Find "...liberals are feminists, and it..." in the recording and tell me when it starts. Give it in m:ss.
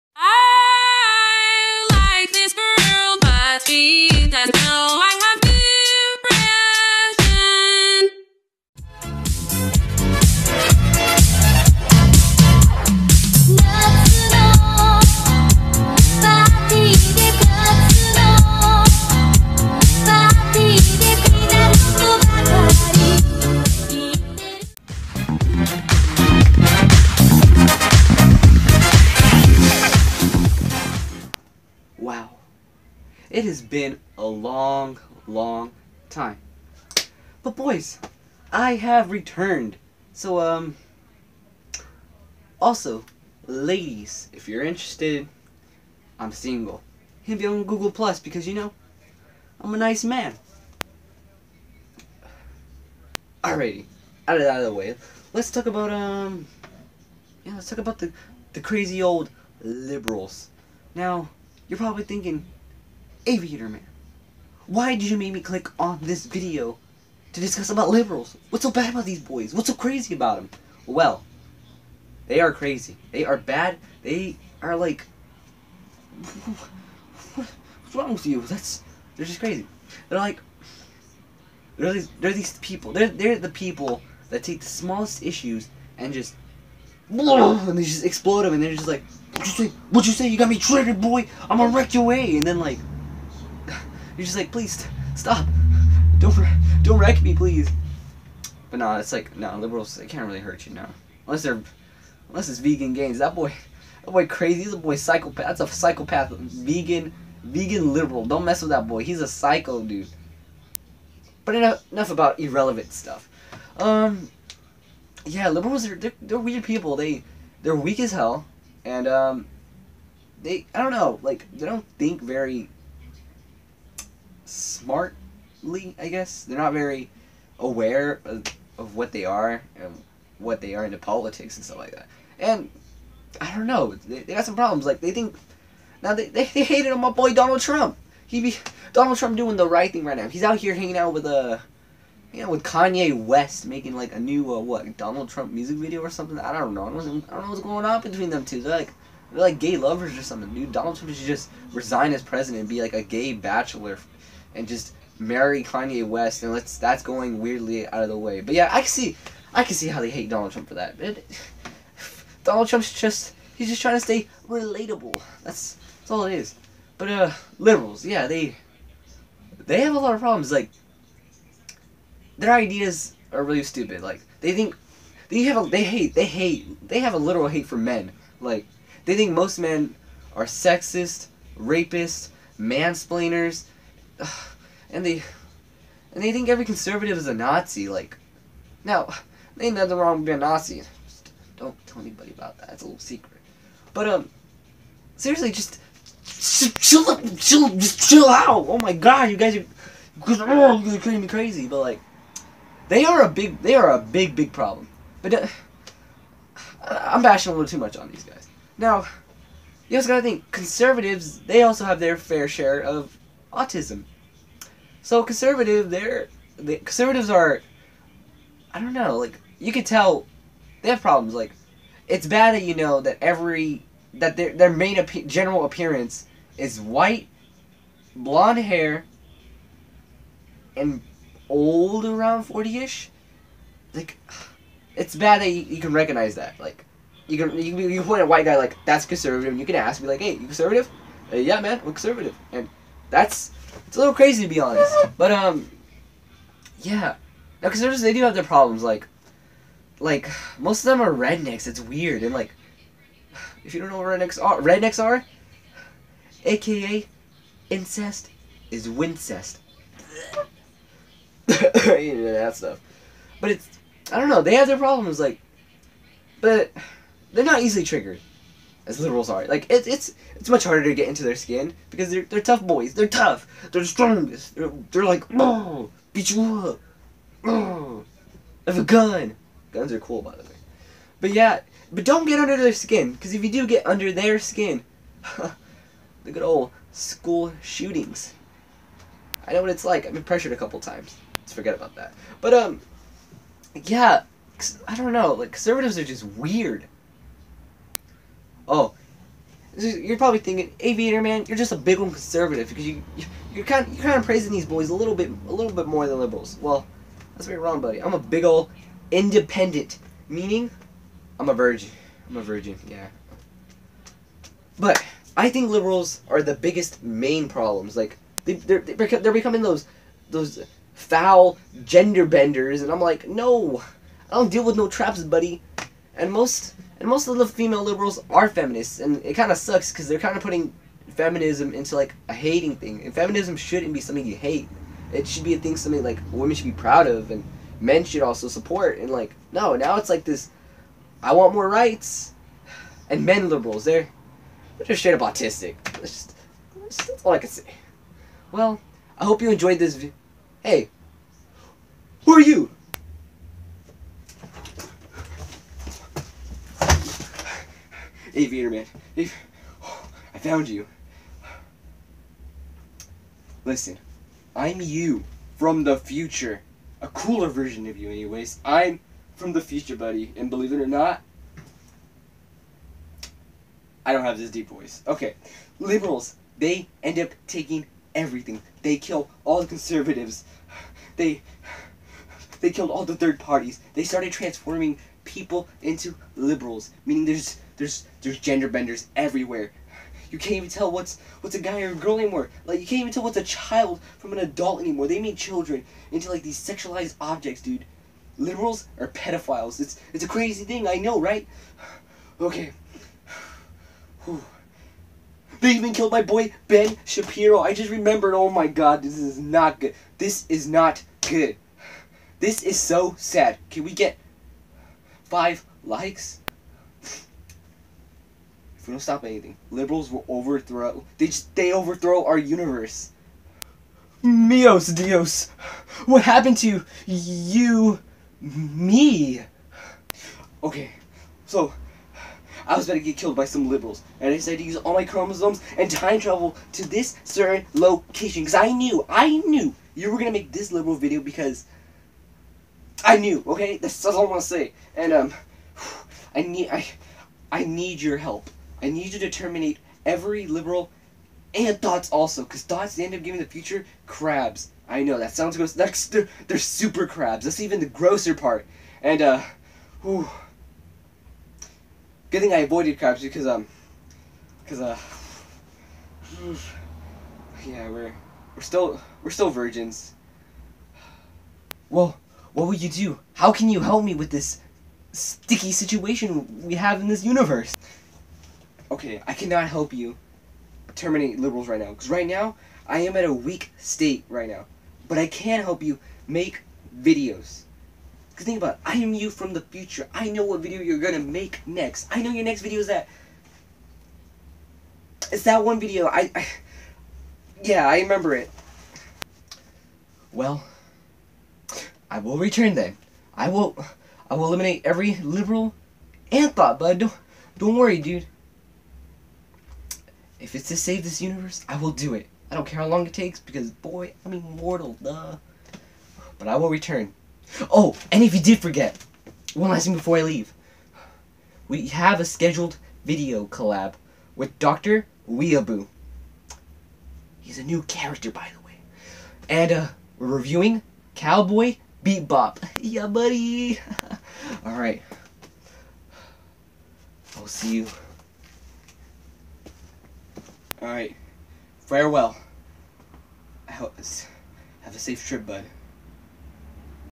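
5:27.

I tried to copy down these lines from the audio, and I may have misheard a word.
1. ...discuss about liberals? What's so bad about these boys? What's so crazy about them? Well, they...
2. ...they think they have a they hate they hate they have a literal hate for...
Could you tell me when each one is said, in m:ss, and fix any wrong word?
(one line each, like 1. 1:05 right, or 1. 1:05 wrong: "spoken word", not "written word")
1. 1:07 right
2. 2:54 right.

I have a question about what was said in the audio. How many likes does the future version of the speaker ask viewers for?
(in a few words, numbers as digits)
5.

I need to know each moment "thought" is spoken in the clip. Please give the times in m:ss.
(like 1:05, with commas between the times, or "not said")
8:26.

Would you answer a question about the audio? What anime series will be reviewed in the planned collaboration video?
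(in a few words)
Cowboy Bebop.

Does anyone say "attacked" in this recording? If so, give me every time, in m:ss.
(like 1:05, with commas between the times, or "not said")
not said.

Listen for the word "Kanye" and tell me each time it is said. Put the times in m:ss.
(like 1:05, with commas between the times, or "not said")
2:22, 2:35.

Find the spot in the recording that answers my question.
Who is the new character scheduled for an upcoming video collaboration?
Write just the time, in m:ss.
8:44.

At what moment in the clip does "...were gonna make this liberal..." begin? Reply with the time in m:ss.
7:20.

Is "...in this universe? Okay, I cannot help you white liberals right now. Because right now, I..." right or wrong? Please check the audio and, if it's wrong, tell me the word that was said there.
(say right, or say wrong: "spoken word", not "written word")
wrong: "terminate", not "white".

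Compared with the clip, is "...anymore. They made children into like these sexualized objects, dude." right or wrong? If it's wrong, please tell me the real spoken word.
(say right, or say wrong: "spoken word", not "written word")
right.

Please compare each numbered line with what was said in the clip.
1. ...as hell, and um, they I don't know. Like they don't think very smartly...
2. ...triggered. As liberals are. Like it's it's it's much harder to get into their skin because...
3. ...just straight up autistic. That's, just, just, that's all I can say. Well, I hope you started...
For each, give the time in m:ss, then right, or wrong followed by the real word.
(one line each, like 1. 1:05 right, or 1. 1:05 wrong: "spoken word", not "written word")
1. 1:57 right
2. 4:27 right
3. 5:44 wrong: "enjoyed", not "started".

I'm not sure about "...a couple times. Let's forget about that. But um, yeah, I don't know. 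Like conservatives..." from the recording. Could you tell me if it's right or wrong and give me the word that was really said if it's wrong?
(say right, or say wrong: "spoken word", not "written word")
right.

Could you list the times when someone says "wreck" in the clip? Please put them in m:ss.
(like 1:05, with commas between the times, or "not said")
1:31, 1:36.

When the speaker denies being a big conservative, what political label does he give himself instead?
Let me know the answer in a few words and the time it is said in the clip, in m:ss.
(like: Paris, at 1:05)
independent, at 5:09.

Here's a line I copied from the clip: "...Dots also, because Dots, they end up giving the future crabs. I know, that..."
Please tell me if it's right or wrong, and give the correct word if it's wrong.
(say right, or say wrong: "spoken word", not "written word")
right.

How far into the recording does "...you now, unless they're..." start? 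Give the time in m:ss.
1:40.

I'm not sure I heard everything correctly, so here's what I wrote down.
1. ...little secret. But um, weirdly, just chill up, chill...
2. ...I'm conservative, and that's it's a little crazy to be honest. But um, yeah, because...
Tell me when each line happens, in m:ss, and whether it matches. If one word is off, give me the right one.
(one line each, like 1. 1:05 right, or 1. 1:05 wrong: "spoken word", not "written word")
1. 3:12 wrong: "seriously", not "weirdly"
2. 4:01 right.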